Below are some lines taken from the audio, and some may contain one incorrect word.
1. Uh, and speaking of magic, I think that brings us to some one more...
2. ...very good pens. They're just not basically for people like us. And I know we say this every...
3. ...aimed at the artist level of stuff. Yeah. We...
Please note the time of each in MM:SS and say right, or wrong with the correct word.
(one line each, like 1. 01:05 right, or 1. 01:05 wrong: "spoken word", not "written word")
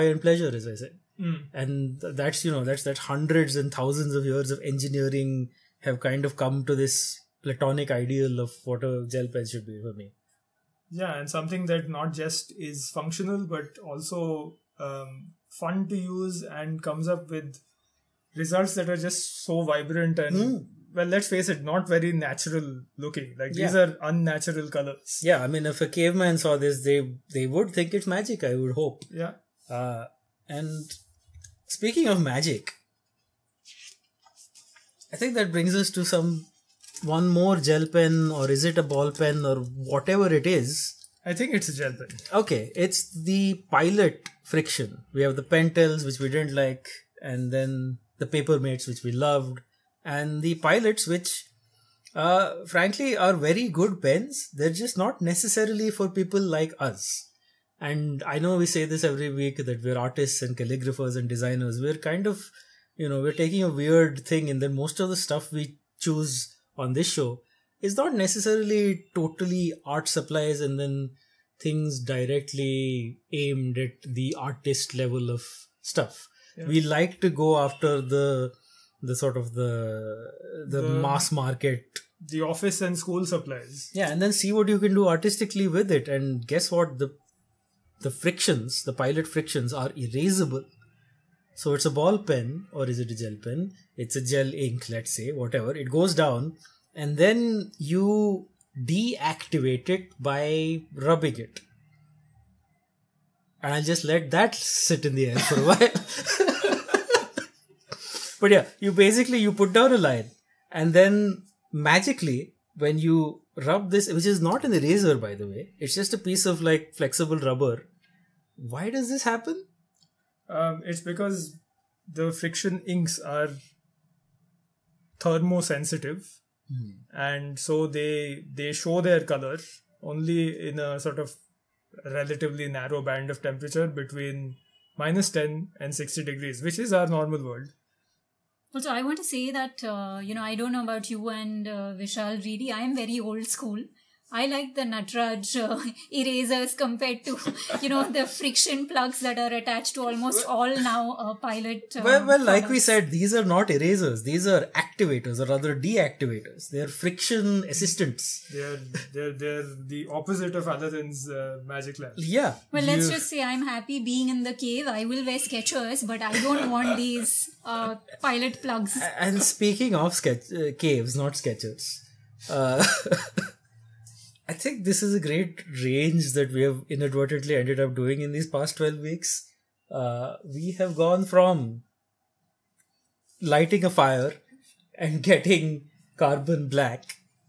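1. 00:29 right
2. 00:53 wrong: "necessarily", not "basically"
3. 01:13 right.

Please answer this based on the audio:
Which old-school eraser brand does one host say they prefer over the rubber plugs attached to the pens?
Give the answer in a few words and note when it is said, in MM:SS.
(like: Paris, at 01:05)
Natraj, at 02:24.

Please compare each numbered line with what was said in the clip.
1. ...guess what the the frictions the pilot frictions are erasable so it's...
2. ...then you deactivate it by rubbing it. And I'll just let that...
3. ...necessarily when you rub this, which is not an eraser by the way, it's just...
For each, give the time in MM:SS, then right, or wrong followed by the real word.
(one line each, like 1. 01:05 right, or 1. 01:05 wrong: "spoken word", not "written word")
1. 01:26 right
2. 01:37 right
3. 01:51 wrong: "magically", not "necessarily".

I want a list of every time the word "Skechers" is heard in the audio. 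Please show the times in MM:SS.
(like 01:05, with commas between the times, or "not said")
02:45, 02:51.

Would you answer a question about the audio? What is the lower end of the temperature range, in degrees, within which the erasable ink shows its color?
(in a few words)
-10.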